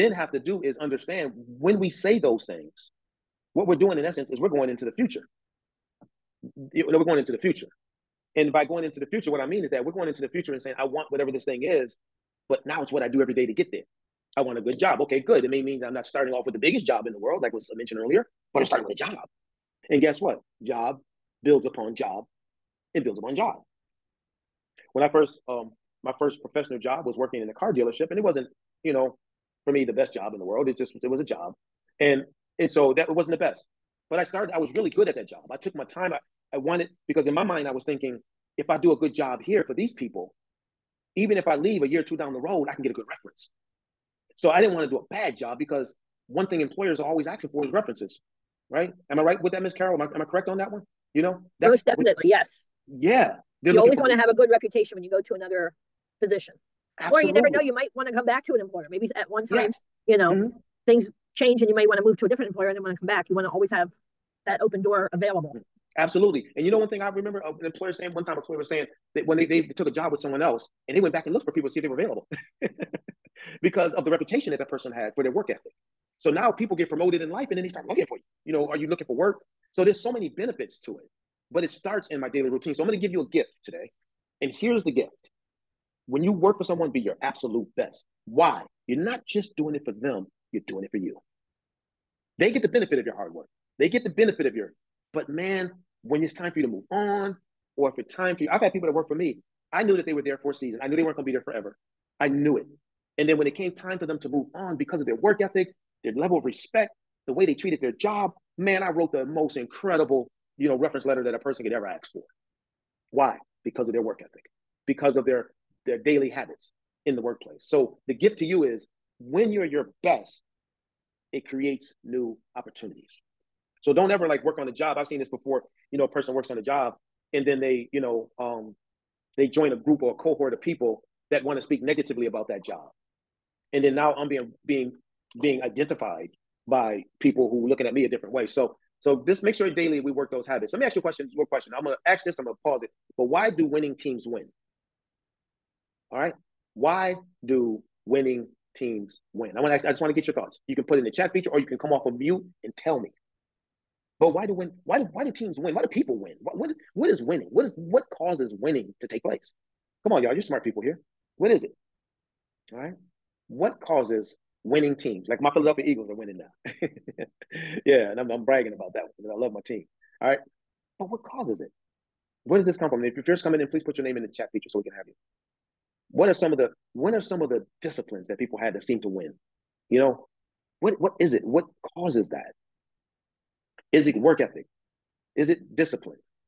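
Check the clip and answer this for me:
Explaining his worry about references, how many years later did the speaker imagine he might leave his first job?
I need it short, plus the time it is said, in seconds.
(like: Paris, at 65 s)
A year or two, at 41 s.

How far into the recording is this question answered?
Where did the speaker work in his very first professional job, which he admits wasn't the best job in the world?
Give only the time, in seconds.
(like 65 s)
27 s.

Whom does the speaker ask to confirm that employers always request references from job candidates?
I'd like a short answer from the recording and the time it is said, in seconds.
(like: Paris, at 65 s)
Miss Carol, at 49 s.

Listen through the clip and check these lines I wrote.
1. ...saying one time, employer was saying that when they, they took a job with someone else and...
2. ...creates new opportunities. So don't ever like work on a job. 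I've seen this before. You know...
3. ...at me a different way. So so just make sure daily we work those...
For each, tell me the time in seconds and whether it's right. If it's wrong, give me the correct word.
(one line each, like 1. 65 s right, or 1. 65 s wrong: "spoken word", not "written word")
1. 67 s right
2. 121 s right
3. 137 s right.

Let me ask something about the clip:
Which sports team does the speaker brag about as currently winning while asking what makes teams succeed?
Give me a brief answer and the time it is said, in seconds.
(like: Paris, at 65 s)
Philadelphia Eagles, at 165 s.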